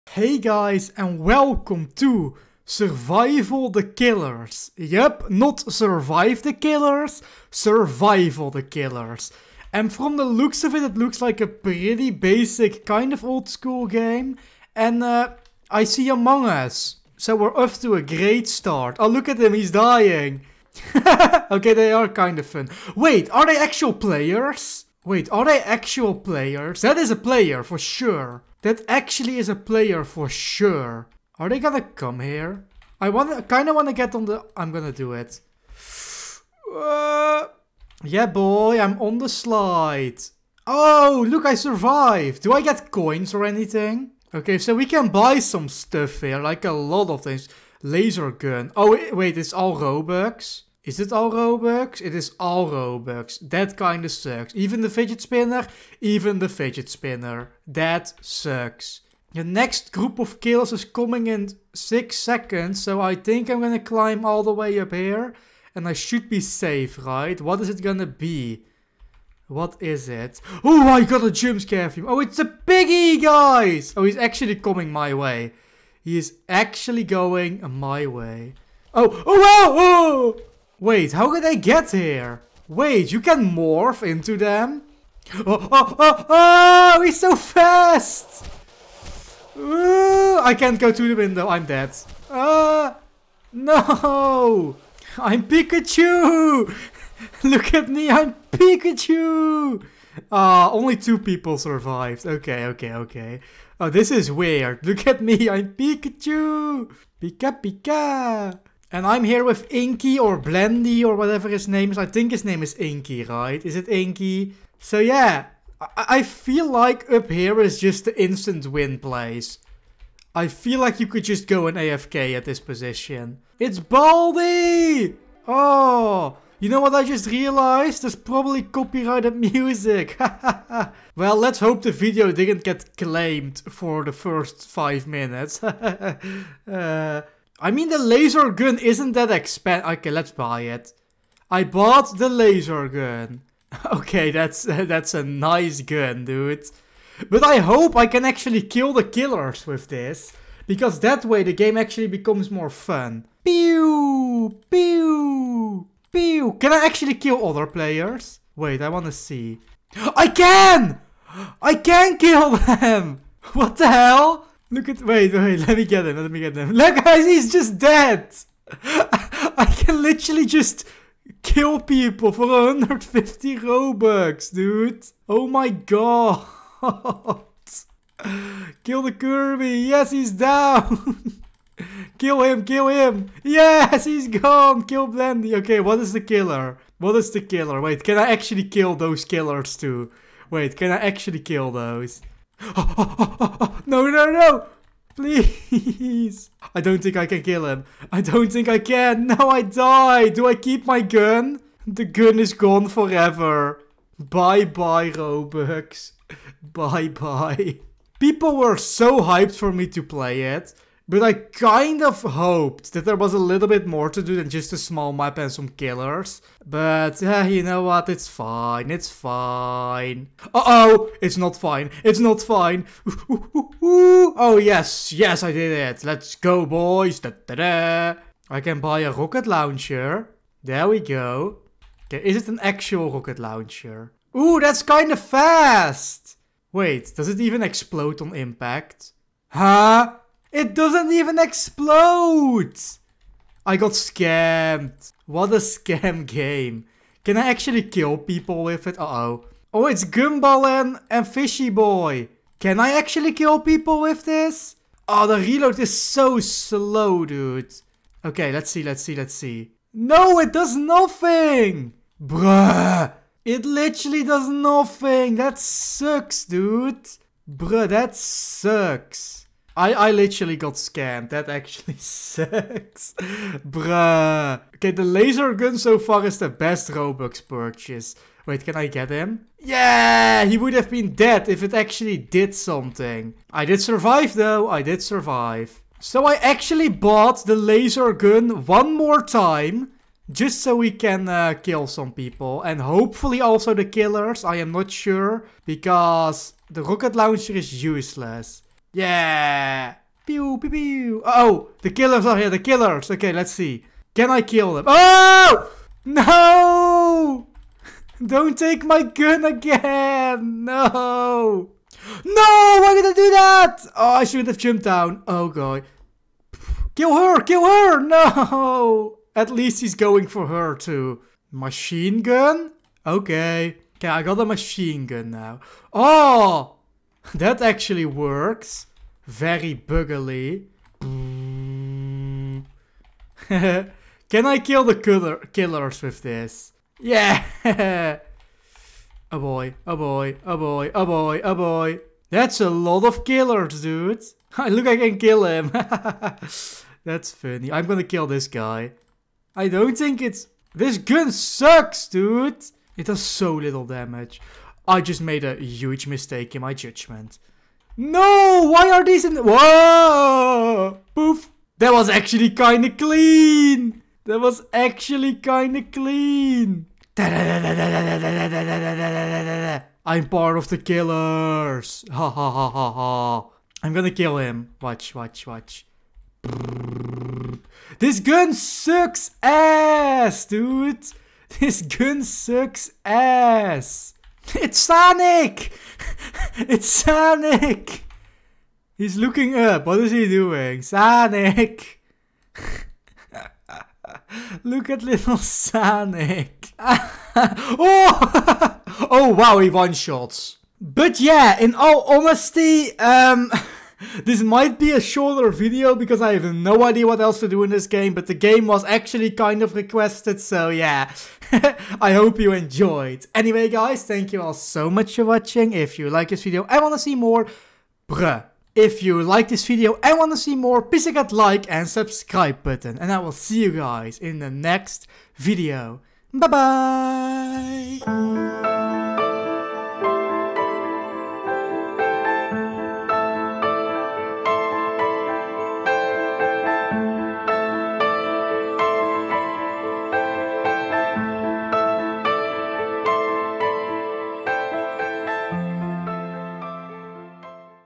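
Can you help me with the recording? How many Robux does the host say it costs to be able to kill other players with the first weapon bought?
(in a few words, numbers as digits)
150.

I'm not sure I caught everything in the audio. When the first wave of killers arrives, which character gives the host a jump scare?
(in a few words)
Piggy.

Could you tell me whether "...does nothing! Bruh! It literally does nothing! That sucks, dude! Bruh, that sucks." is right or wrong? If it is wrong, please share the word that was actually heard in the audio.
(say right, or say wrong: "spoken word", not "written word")
right.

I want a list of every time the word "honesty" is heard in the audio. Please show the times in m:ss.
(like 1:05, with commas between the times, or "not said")
6:42.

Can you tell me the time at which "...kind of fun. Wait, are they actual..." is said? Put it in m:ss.
0:22.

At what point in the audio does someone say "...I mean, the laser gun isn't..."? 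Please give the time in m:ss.
2:17.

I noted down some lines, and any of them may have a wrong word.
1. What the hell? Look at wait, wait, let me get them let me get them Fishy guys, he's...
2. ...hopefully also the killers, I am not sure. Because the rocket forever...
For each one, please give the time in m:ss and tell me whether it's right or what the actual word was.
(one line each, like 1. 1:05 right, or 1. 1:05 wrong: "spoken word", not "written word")
1. 2:43 wrong: "Look", not "Fishy"
2. 4:52 wrong: "launcher", not "forever".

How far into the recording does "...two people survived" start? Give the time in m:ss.
1:40.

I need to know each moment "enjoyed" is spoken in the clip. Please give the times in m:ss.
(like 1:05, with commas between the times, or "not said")
6:52.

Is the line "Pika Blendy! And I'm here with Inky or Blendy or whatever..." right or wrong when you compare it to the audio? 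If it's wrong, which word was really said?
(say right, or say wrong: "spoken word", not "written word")
wrong: "Pika", not "Blendy".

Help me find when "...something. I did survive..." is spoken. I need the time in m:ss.
4:42.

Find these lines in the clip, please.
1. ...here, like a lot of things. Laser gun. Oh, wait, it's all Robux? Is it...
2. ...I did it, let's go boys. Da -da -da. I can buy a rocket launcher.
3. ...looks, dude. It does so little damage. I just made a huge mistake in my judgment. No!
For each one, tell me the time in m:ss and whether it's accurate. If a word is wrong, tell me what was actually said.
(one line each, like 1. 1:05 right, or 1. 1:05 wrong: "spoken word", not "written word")
1. 0:46 right
2. 3:45 right
3. 5:51 wrong: "sucks", not "looks".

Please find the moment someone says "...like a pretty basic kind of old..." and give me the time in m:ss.
0:11.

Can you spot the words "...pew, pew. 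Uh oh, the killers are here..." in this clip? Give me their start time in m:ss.
5:00.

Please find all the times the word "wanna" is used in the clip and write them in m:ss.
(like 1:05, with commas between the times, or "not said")
0:33, 2:38.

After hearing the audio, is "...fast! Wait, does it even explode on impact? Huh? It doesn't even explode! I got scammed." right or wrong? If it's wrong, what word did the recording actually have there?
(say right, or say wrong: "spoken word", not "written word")
right.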